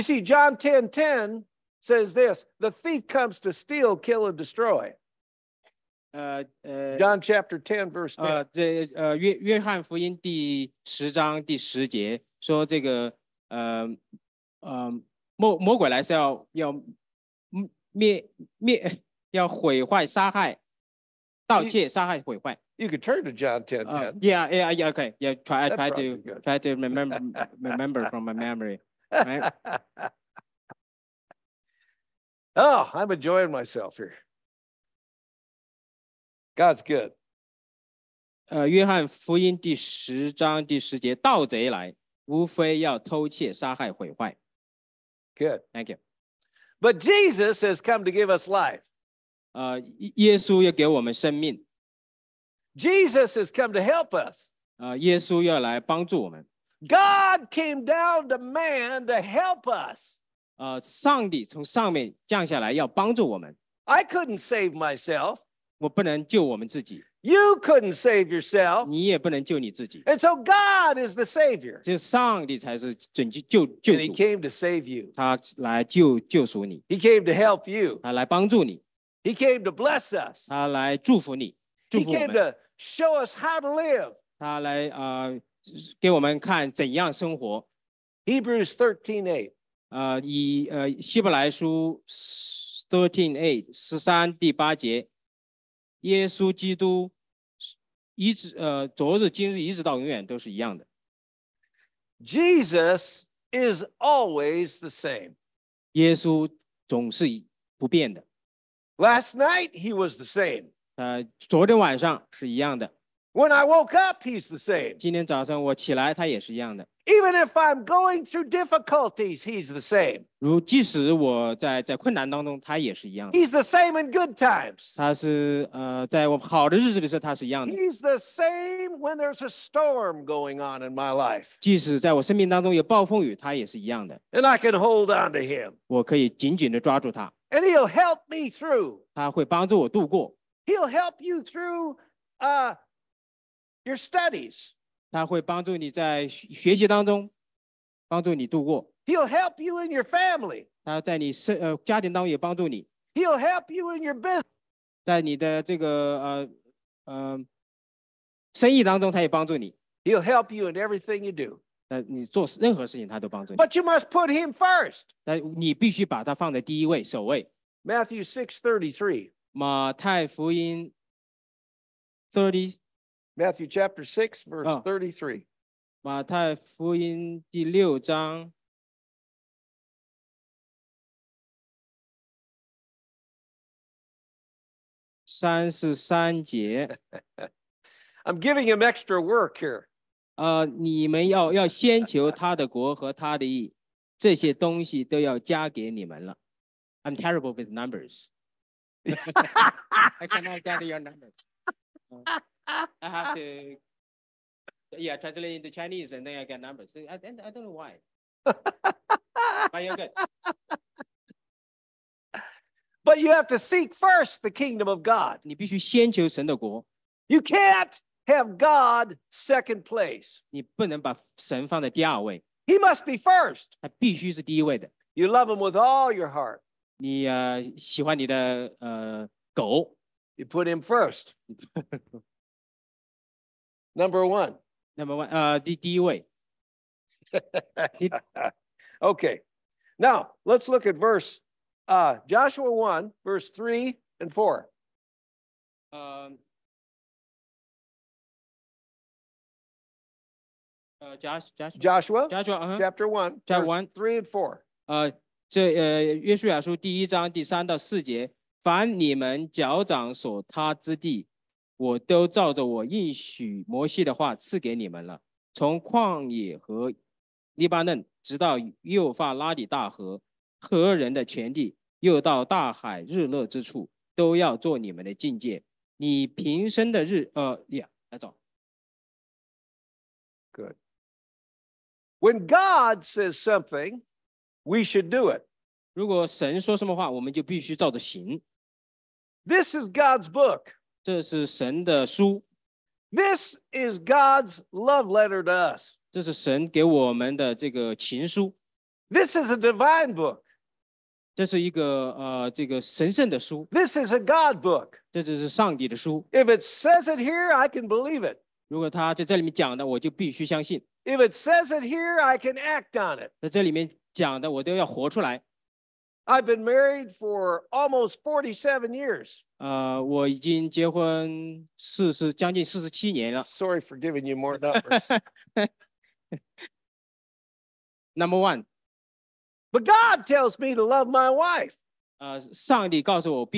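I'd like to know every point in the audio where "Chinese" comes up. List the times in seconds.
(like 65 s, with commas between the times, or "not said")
205 s.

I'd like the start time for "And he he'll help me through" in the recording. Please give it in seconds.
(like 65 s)
135 s.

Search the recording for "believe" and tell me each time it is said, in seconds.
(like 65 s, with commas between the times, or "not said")
307 s.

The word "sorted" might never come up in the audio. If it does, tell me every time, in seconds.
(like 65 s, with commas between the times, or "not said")
not said.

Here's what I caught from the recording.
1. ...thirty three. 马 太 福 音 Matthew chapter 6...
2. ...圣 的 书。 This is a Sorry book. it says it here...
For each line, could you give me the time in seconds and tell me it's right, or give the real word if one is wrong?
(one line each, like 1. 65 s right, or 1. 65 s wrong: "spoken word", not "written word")
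1. 168 s right
2. 303 s wrong: "God", not "Sorry".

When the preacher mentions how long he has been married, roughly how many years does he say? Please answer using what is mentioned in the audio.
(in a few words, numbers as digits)
47.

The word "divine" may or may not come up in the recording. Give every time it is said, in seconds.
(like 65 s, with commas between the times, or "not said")
299 s.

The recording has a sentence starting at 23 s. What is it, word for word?
呃 uh, yeah, yeah, yeah, okay, yeah.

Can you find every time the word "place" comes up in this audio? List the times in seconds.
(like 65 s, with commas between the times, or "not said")
219 s.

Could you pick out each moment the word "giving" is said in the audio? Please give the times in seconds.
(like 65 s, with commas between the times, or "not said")
188 s, 323 s.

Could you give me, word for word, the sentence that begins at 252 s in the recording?
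chapter 1, chapter 1, 3 and 4.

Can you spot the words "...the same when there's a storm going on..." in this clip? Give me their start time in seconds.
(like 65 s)
128 s.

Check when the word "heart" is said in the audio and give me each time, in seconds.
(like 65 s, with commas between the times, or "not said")
226 s.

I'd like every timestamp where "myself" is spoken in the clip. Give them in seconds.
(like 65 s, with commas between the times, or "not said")
33 s, 64 s.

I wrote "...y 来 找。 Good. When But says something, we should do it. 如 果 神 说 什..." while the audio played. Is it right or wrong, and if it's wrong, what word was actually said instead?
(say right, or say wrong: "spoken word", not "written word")
wrong: "God", not "But".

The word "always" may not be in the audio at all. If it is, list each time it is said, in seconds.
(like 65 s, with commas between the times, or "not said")
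103 s.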